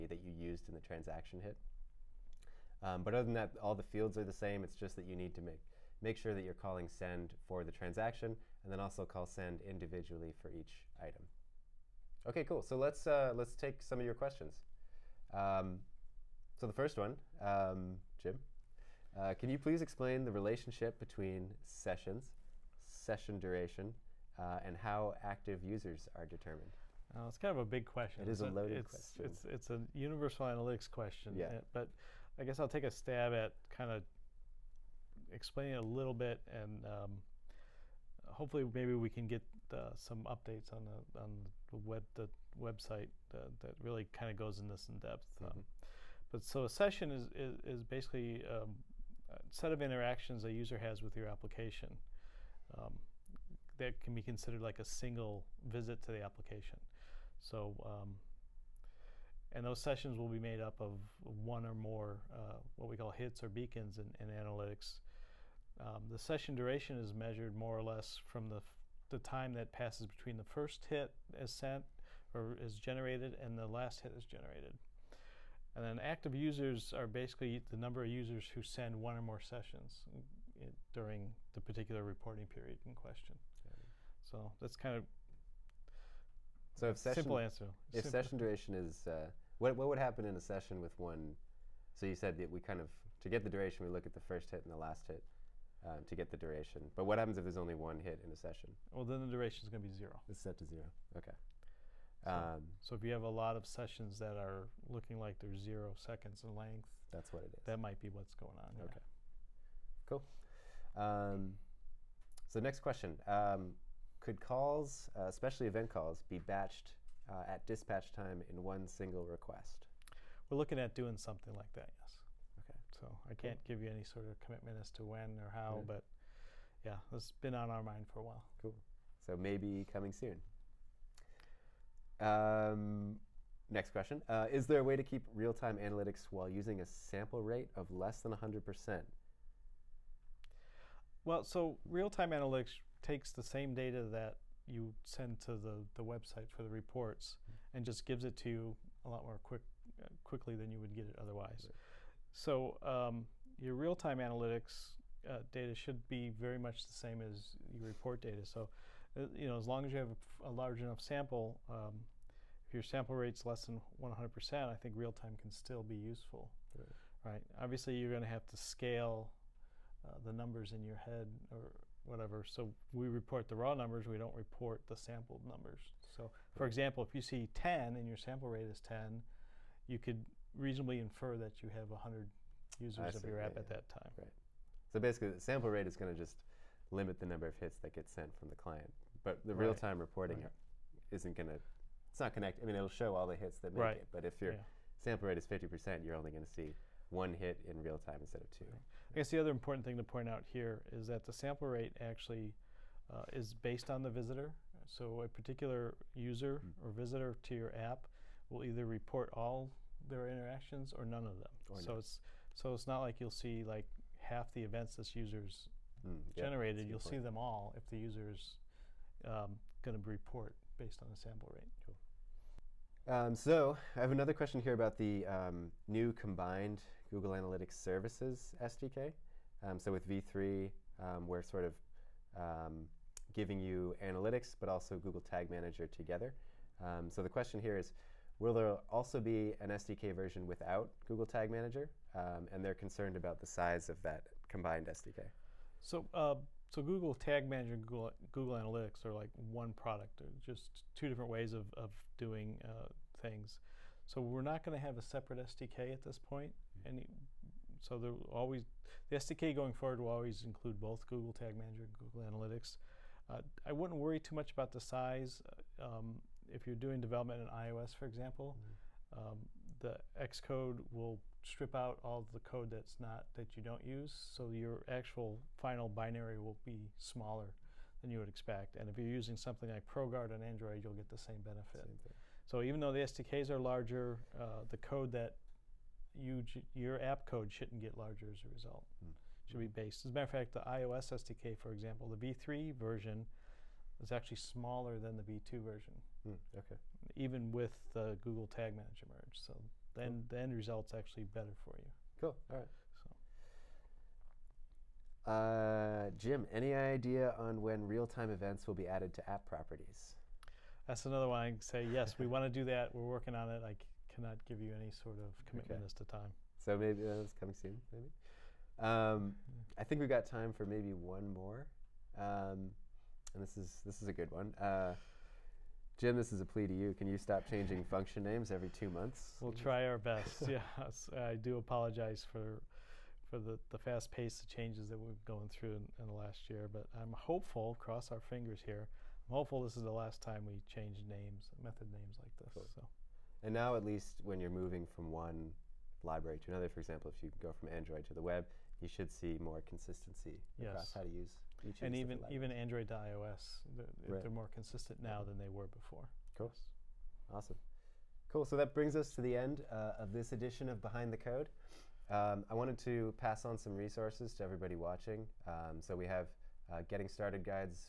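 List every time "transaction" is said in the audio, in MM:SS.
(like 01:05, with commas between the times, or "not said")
00:00, 00:07.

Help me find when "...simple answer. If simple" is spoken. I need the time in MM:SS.
01:27.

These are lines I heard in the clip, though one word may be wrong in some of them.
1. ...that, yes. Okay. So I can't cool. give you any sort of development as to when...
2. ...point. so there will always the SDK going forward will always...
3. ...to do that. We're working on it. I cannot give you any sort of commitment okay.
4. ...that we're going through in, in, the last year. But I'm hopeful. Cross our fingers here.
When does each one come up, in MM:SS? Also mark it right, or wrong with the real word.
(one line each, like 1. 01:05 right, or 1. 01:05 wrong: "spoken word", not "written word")
1. 02:01 wrong: "commitment", not "development"
2. 04:16 right
3. 05:12 right
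4. 05:34 right.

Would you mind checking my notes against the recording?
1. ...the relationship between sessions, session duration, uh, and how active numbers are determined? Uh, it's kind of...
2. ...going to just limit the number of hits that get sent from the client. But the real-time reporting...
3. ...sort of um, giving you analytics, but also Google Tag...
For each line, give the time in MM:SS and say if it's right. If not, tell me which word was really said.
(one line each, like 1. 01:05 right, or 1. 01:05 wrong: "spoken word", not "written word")
1. 00:20 wrong: "users", not "numbers"
2. 03:05 right
3. 03:51 right.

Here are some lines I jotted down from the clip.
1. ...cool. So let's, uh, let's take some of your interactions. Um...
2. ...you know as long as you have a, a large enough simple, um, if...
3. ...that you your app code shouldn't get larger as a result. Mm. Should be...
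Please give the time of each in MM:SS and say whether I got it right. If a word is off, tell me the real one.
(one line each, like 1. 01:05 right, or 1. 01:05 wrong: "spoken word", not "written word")
1. 00:12 wrong: "questions", not "interactions"
2. 02:39 wrong: "sample", not "simple"
3. 04:45 right.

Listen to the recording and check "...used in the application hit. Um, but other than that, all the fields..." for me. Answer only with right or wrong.
wrong.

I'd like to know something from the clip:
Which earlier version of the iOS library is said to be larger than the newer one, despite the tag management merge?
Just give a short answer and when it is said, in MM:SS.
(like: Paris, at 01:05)
V2, at 04:55.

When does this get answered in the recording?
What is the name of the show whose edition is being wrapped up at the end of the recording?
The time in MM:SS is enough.
06:00.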